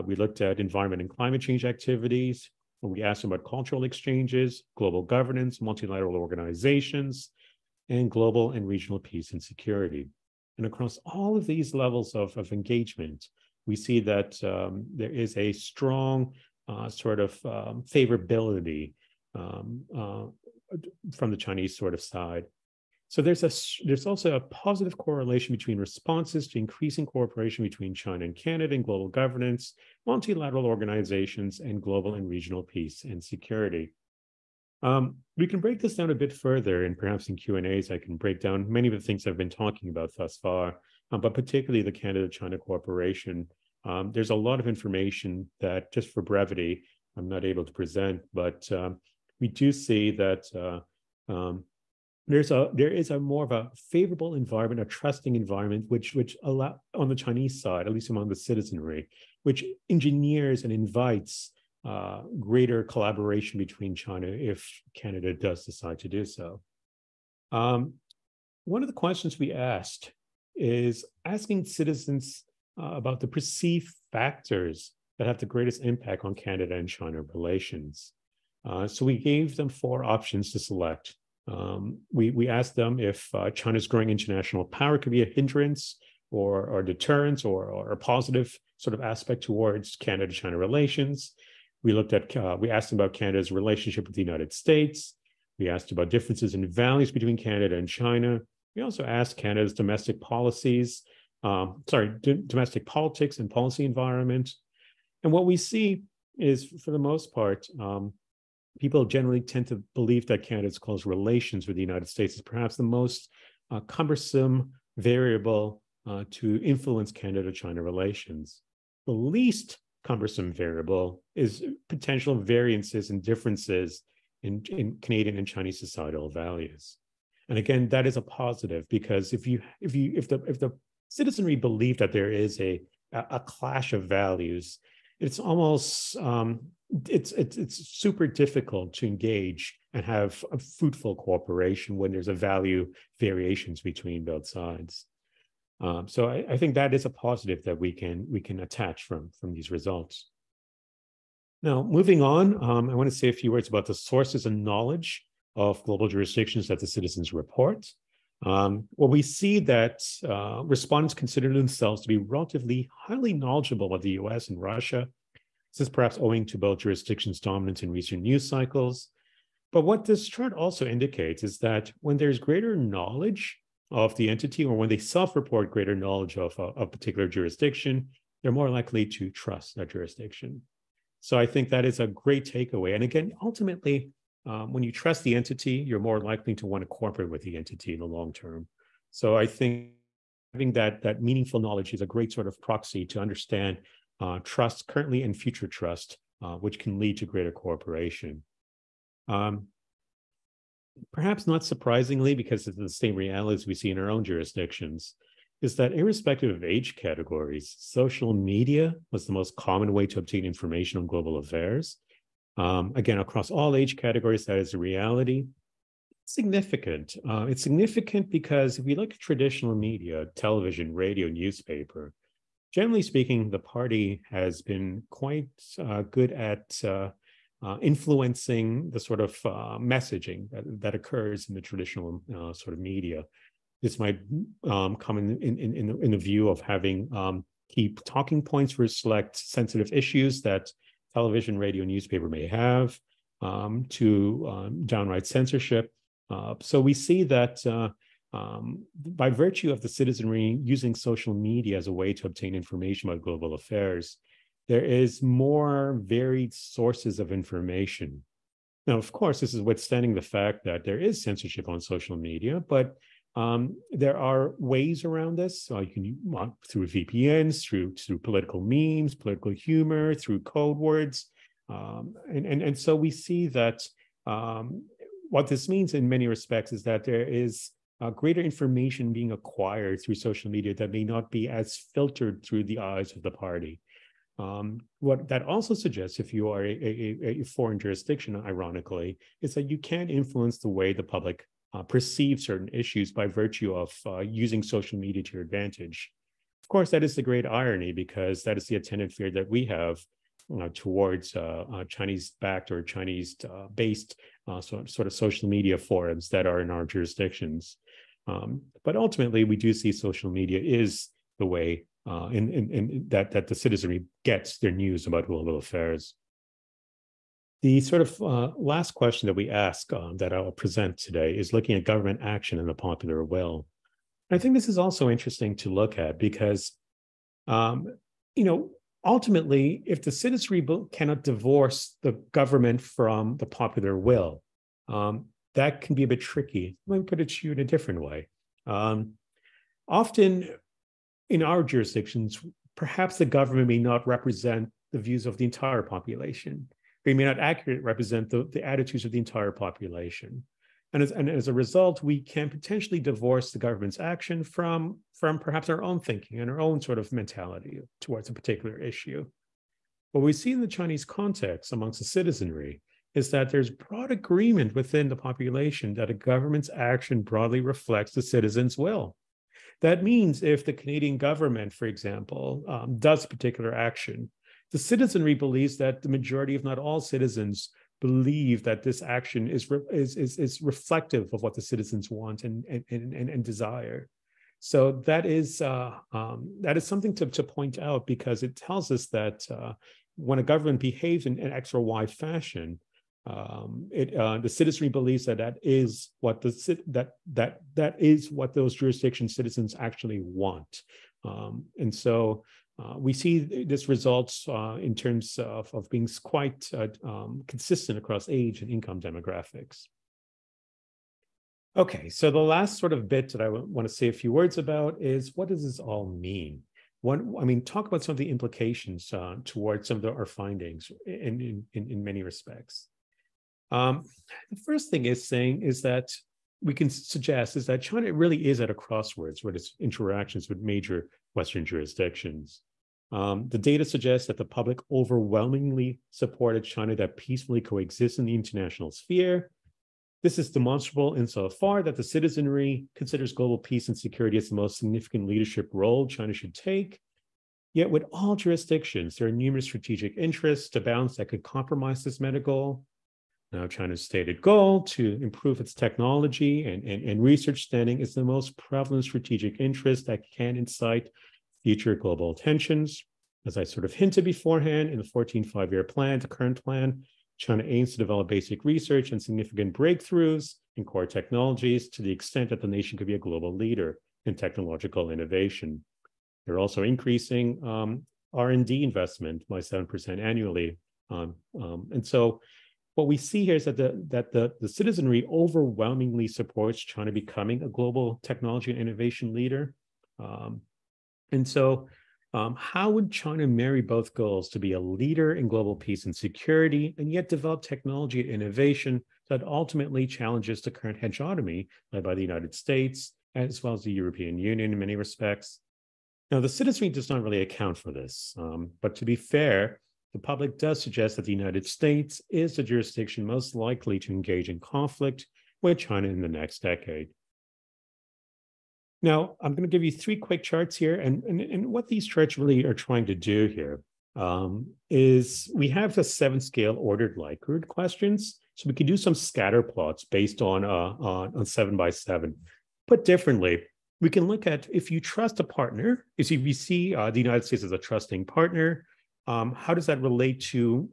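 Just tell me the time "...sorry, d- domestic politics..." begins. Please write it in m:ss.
1:41.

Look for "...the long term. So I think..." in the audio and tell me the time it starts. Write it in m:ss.
3:07.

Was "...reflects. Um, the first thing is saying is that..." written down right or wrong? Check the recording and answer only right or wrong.
wrong.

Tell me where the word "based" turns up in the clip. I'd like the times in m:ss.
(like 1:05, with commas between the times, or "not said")
5:02, 8:50.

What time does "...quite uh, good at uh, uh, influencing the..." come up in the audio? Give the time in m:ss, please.
3:45.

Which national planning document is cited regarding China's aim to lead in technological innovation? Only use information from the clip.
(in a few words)
14th five-year plan.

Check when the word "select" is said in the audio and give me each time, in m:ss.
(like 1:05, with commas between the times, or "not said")
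1:20, 3:59.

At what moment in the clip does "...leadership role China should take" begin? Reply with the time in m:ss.
7:25.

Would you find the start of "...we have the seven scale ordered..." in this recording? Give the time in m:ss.
8:45.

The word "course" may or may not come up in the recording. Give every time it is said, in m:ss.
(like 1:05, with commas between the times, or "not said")
4:19, 4:56.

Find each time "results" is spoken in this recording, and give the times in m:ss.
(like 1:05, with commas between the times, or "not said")
2:29, 5:51, 6:43.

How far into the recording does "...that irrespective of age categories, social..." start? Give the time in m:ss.
3:25.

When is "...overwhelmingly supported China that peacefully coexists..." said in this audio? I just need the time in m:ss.
7:14.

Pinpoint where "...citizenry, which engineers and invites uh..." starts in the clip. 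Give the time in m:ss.
0:58.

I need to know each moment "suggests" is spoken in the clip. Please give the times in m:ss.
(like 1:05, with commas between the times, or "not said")
4:45, 7:06, 7:13, 8:30.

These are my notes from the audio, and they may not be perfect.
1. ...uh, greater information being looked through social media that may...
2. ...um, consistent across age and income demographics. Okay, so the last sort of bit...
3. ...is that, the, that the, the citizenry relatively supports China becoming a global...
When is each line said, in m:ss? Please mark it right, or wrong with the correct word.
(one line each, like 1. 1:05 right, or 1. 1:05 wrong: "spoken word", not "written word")
1. 4:38 wrong: "acquired", not "looked"
2. 6:47 right
3. 8:03 wrong: "overwhelmingly", not "relatively".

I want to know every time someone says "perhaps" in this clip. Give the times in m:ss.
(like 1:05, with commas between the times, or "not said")
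0:36, 1:52, 2:45, 3:21, 5:42, 5:55.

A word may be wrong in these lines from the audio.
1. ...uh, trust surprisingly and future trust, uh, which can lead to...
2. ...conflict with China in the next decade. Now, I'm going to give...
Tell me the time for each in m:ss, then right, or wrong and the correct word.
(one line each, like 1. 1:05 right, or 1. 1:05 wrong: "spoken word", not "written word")
1. 3:14 wrong: "currently", not "surprisingly"
2. 8:34 right.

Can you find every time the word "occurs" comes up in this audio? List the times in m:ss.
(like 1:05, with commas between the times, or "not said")
3:50.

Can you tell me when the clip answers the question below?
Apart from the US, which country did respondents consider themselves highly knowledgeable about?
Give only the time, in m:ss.
2:44.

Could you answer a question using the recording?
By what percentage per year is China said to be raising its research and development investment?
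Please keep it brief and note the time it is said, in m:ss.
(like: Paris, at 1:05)
7%, at 7:59.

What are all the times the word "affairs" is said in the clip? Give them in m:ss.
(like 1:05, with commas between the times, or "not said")
3:31, 4:13, 5:15.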